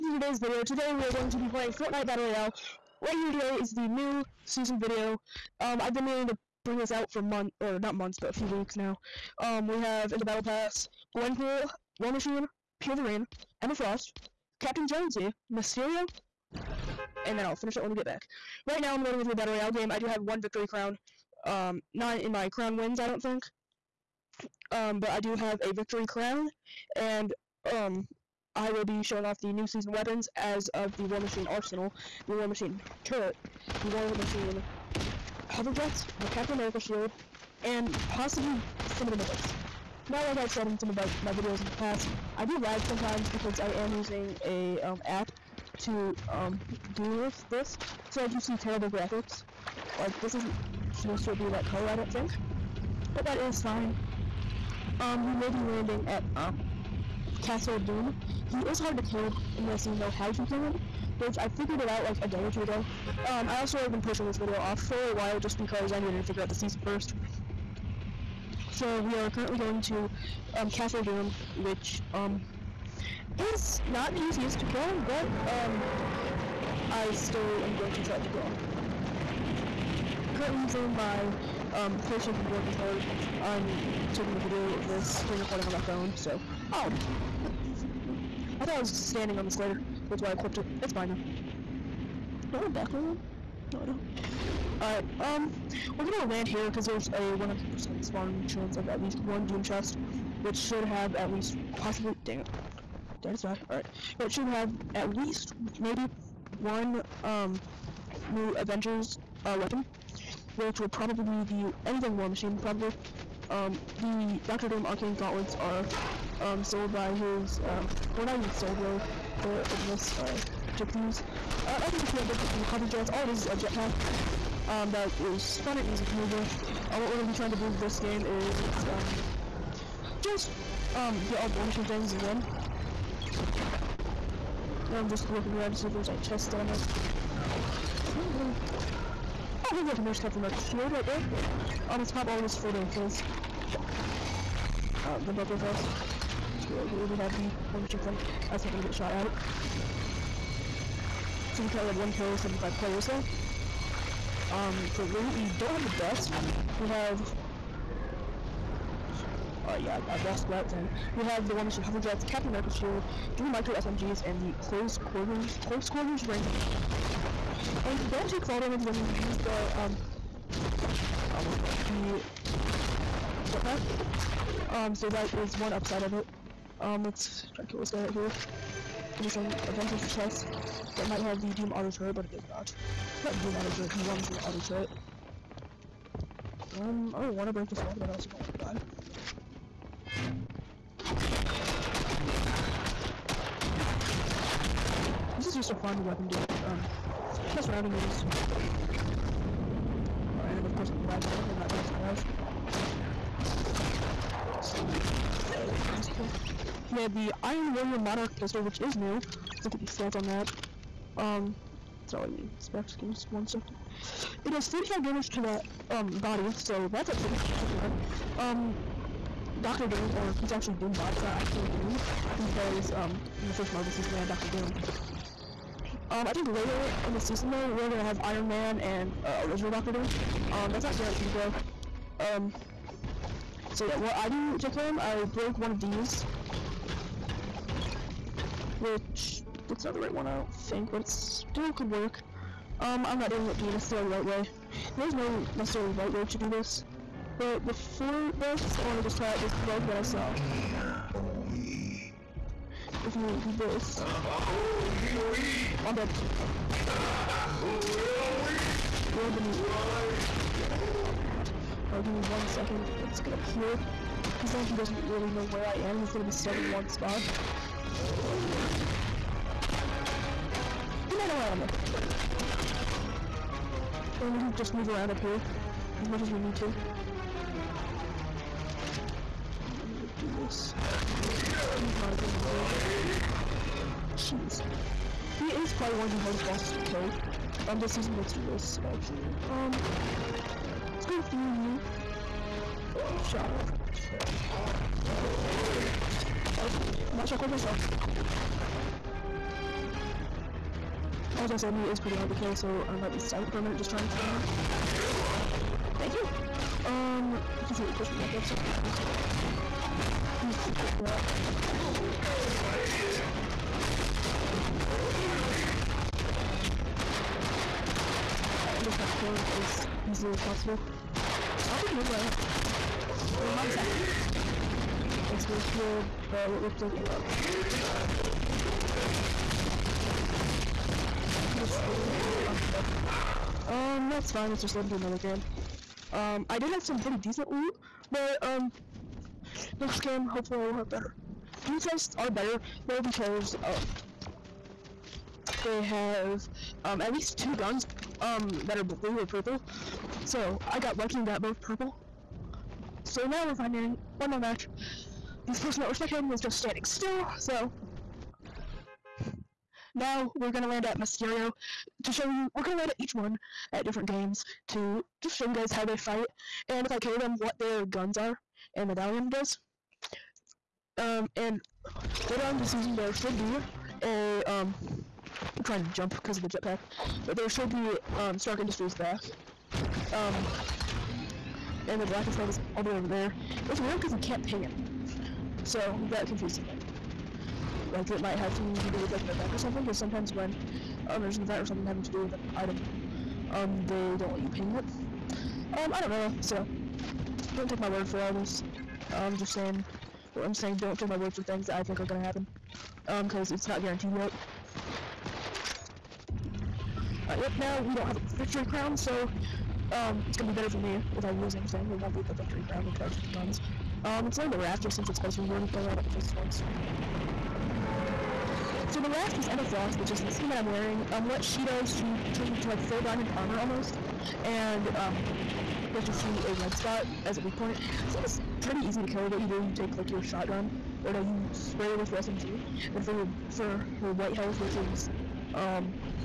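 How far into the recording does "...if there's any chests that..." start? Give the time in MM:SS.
02:15.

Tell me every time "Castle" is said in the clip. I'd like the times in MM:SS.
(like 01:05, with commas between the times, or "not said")
00:57, 01:10.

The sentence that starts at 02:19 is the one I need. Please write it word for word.
Oh, hey, look, and there's Captain America's shield right there.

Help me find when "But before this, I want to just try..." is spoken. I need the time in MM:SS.
04:07.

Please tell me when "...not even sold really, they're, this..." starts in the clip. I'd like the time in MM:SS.
01:58.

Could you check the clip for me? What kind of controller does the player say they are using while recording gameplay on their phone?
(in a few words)
PlayStation 4 controller.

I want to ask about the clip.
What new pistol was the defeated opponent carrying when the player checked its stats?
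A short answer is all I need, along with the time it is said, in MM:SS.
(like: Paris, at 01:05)
Iron Warrior Monarch pistol, at 03:27.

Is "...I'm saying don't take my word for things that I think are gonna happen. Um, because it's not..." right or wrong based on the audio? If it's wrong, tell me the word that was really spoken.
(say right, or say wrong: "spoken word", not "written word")
right.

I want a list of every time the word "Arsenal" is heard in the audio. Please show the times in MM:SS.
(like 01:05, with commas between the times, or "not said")
00:31.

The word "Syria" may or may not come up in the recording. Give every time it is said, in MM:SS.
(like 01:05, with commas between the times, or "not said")
not said.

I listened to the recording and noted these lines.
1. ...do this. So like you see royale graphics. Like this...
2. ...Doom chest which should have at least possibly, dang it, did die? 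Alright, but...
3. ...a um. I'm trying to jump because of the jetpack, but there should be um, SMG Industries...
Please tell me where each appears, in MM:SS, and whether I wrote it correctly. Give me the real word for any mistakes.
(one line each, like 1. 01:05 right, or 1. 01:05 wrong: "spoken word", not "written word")
1. 00:46 wrong: "terrible", not "royale"
2. 01:39 right
3. 06:14 wrong: "Stark", not "SMG".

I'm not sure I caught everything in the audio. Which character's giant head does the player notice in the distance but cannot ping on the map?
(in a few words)
Galactus.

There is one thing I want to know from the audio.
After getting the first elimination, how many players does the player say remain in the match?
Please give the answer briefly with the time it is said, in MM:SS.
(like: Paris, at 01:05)
75, at 02:32.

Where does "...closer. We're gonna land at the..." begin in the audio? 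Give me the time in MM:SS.
06:55.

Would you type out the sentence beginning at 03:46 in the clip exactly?
Um, I think later in the season though, we're gonna have Iron Man and uh, original Doctor Doom.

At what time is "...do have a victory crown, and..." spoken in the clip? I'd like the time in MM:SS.
00:25.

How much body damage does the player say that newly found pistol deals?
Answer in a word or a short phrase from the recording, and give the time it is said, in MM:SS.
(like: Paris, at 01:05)
45, at 03:34.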